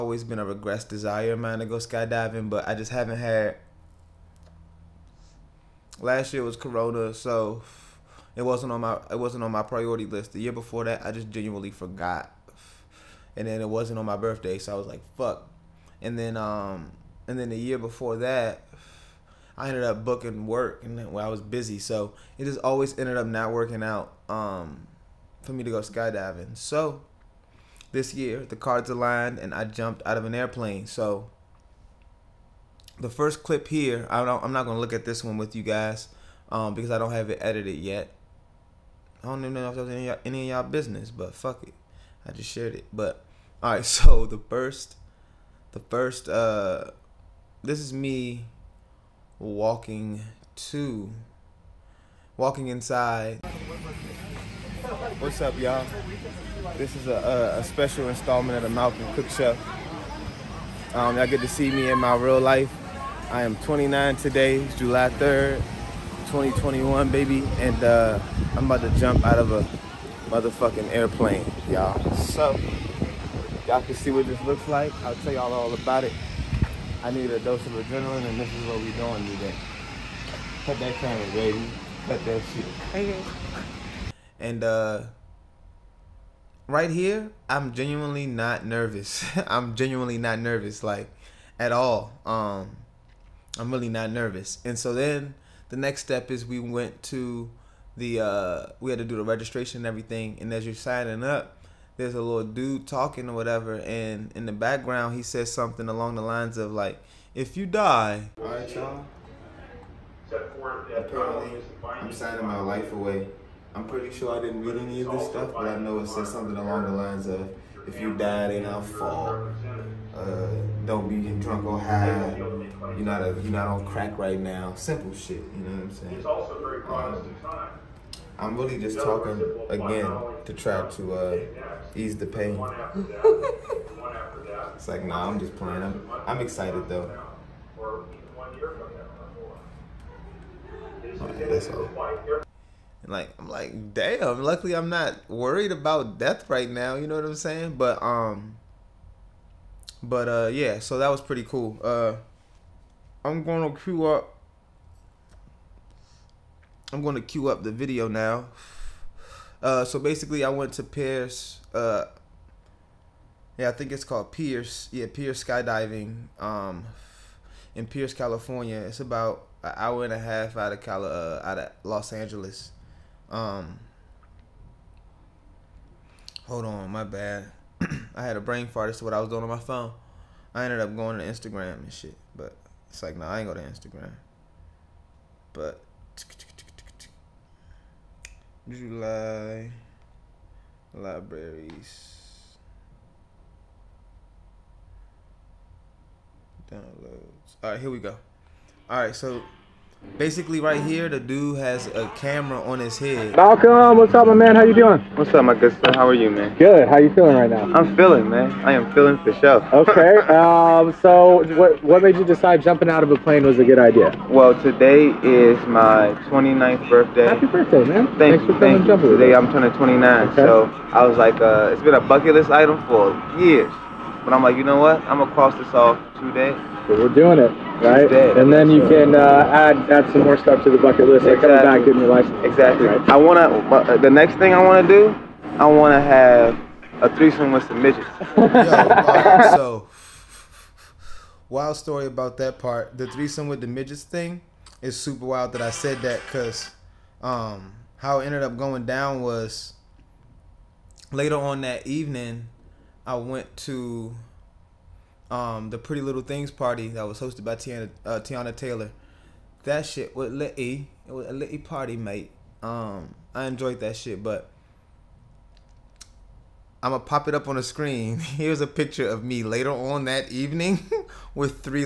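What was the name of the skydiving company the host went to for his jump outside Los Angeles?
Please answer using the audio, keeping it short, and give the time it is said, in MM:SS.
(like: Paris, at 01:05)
Pierce Skydiving, at 02:45.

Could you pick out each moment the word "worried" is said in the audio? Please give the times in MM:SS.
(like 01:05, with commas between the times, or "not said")
02:25.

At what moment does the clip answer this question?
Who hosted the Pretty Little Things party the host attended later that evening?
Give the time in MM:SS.
04:18.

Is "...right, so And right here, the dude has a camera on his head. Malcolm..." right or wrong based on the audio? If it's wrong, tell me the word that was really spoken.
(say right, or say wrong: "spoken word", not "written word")
wrong: "Basically", not "And".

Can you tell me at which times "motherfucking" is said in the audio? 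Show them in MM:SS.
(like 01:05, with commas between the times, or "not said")
01:10.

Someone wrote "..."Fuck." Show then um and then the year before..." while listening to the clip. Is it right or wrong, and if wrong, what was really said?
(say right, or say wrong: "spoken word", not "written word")
wrong: "And", not "Show".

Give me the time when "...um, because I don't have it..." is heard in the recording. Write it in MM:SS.
00:36.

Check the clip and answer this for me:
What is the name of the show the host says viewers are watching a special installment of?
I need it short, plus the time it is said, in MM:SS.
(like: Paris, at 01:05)
The Malcolm Cook Show, at 00:58.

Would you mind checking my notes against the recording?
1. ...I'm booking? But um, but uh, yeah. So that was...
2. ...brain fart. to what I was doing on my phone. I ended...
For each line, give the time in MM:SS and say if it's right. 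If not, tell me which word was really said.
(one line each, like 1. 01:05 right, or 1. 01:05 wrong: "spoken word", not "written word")
1. 02:27 wrong: "saying", not "booking"
2. 02:58 right.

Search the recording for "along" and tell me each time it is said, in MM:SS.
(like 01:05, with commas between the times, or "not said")
01:45, 01:56.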